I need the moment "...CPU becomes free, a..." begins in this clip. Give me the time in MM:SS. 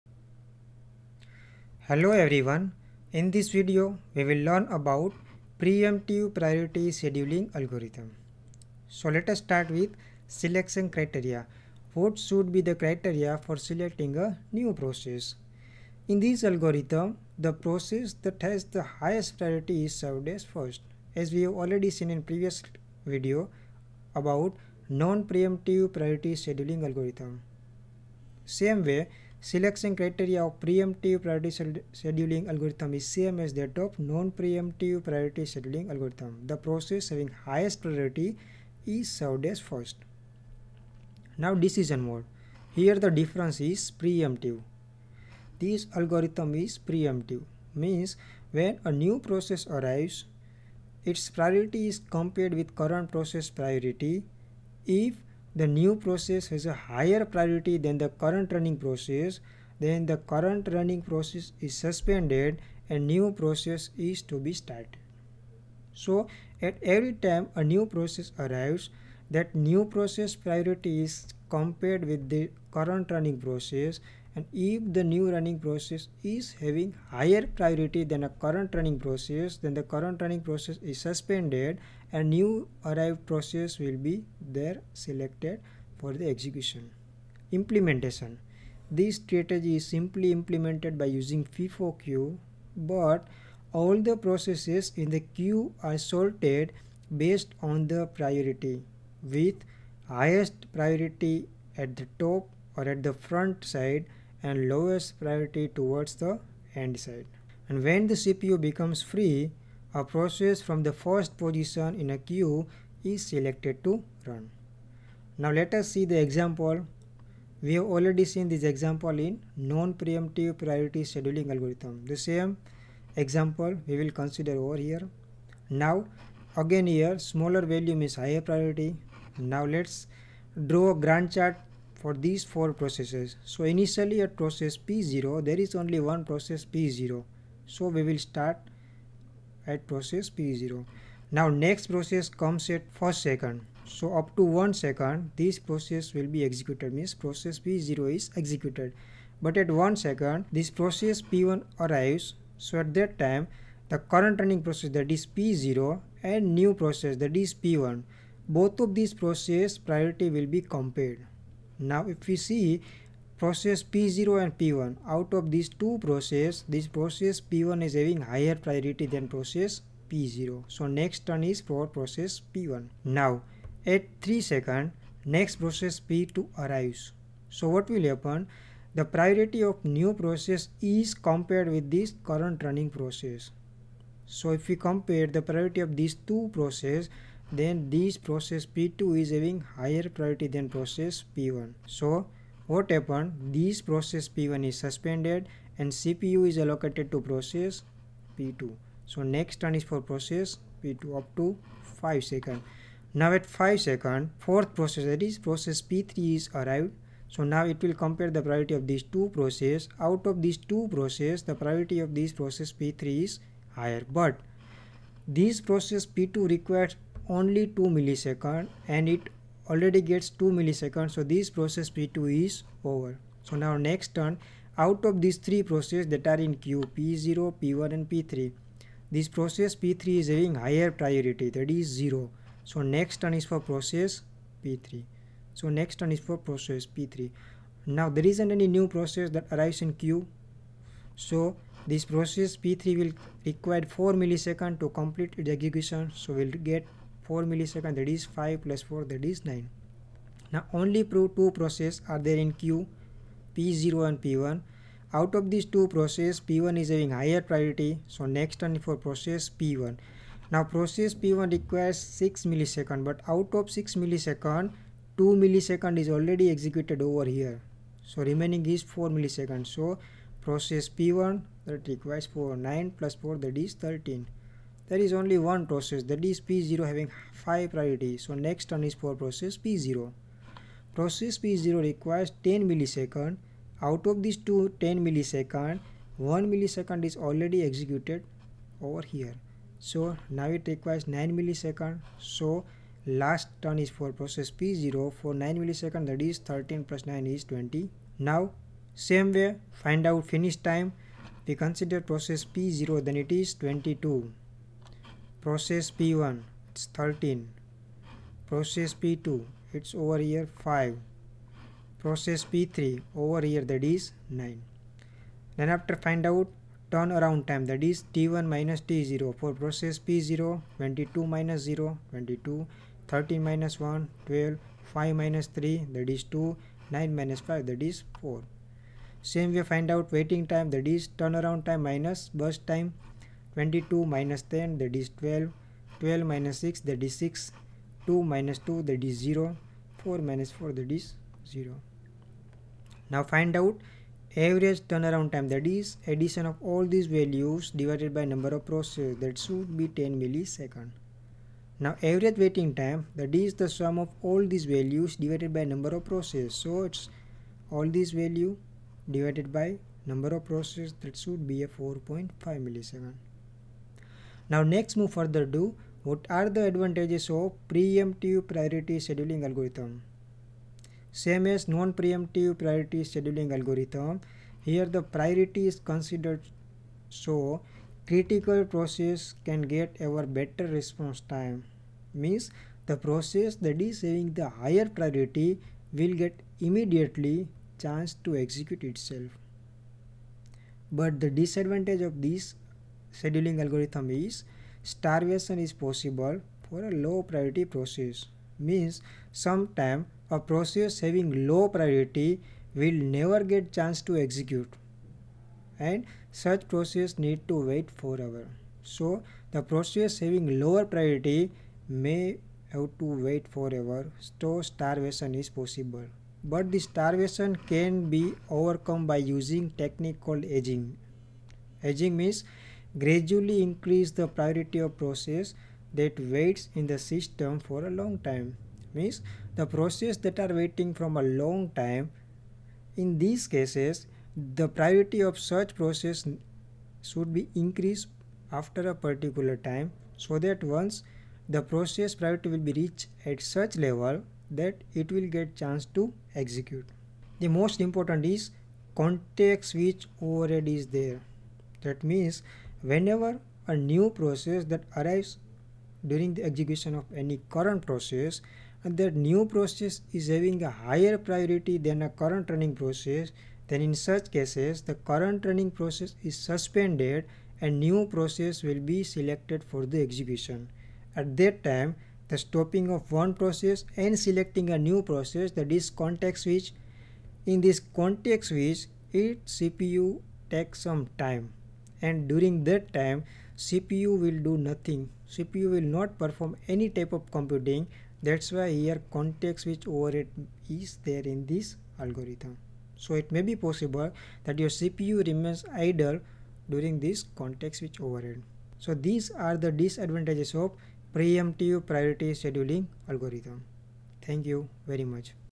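01:48.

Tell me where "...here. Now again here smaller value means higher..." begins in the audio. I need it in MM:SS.
02:04.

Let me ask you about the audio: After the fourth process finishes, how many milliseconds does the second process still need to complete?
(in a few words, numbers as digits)
4 milliseconds.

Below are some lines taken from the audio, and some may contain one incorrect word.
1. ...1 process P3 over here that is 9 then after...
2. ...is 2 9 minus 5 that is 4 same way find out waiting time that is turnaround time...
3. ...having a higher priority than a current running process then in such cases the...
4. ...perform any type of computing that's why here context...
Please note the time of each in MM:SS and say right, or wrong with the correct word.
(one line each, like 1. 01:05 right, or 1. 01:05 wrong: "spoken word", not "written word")
1. 05:10 wrong: "5", not "1"
2. 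05:26 right
3. 07:40 right
4. 08:06 right.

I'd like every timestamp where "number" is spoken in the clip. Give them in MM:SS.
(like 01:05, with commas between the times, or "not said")
05:48, 05:55, 06:00.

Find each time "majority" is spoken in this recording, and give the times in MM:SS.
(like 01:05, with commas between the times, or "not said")
not said.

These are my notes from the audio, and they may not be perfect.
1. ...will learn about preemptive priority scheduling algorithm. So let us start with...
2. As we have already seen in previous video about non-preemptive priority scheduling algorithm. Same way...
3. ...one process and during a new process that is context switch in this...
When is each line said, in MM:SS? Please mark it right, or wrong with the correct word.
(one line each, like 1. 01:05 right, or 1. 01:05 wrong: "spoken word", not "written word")
1. 00:04 right
2. 00:21 right
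3. 07:53 wrong: "selecting", not "during".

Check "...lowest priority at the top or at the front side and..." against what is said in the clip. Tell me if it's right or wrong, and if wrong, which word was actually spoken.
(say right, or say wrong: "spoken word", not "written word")
wrong: "highest", not "lowest".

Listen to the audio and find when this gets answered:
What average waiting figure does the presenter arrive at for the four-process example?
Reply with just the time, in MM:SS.
06:01.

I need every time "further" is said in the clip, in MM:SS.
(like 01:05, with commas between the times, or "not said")
06:05.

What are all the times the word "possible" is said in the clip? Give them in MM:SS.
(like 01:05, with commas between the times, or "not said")
06:35, 06:55, 08:13.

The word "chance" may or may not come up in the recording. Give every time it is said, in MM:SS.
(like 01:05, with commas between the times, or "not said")
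06:27, 06:43, 07:25.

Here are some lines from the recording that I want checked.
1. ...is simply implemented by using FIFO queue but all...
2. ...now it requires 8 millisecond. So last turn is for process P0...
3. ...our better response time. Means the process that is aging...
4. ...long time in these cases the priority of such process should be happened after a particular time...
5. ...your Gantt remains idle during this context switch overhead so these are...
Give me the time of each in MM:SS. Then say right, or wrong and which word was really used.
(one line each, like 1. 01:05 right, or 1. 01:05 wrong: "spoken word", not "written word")
1. 01:29 right
2. 04:50 wrong: "9", not "8"
3. 06:20 wrong: "having", not "aging"
4. 07:11 wrong: "increased", not "happened"
5. 08:14 wrong: "CPU", not "Gantt".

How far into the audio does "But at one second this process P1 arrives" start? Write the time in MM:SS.
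02:29.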